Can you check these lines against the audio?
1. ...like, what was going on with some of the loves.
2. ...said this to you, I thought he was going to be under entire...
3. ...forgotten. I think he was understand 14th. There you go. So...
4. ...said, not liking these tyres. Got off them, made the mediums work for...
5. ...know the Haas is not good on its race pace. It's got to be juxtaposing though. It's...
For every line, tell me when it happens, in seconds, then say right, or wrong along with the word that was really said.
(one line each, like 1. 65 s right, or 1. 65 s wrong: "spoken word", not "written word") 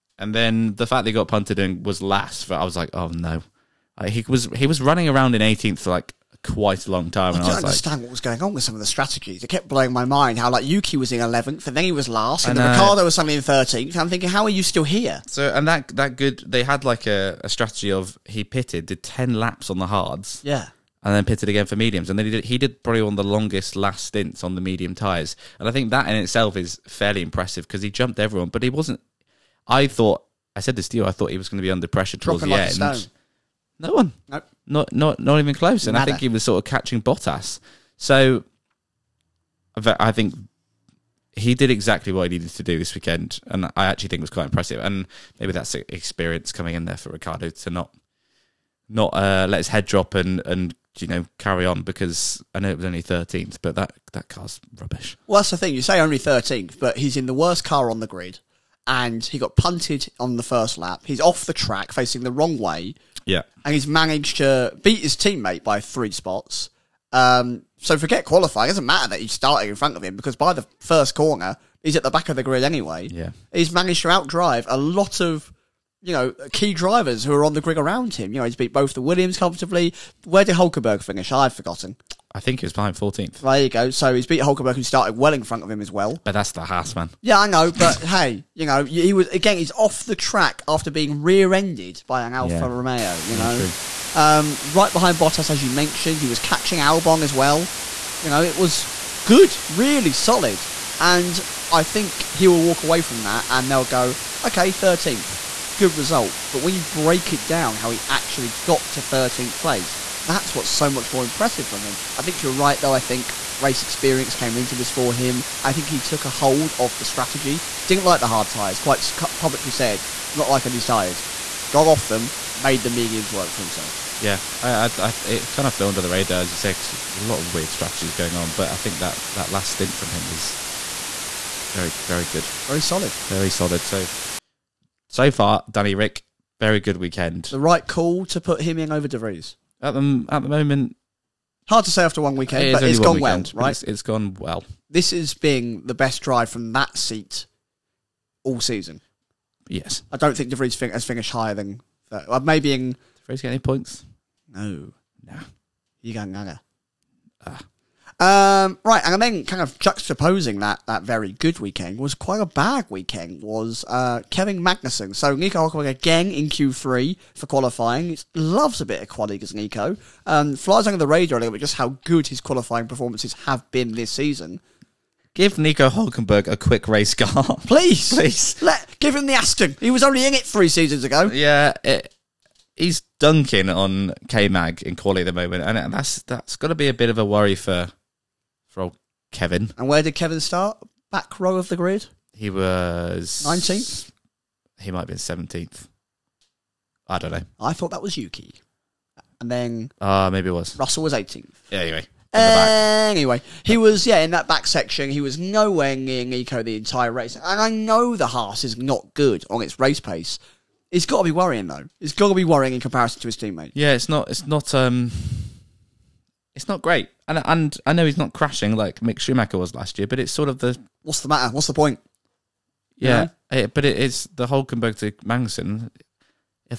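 1. 7 s wrong: "strategies", not "loves"
2. 30 s wrong: "pressure", not "entire"
3. 81 s wrong: "behind", not "understand"
4. 119 s right
5. 207 s wrong: "worrying", not "juxtaposing".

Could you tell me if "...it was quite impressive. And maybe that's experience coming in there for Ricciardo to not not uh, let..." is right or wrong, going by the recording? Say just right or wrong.
right.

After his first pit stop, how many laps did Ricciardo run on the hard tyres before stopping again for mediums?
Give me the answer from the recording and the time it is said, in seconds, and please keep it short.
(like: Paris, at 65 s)
10, at 19 s.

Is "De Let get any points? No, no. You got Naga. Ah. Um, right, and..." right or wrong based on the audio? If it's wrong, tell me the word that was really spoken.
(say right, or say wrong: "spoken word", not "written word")
wrong: "Vries", not "Let".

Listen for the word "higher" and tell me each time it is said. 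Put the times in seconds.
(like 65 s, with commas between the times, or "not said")
151 s.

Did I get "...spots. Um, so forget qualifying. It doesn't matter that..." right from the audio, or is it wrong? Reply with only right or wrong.
right.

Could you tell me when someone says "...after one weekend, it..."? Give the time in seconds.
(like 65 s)
142 s.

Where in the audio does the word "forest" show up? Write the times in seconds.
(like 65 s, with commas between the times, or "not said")
not said.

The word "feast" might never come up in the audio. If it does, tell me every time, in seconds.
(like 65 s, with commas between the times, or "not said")
not said.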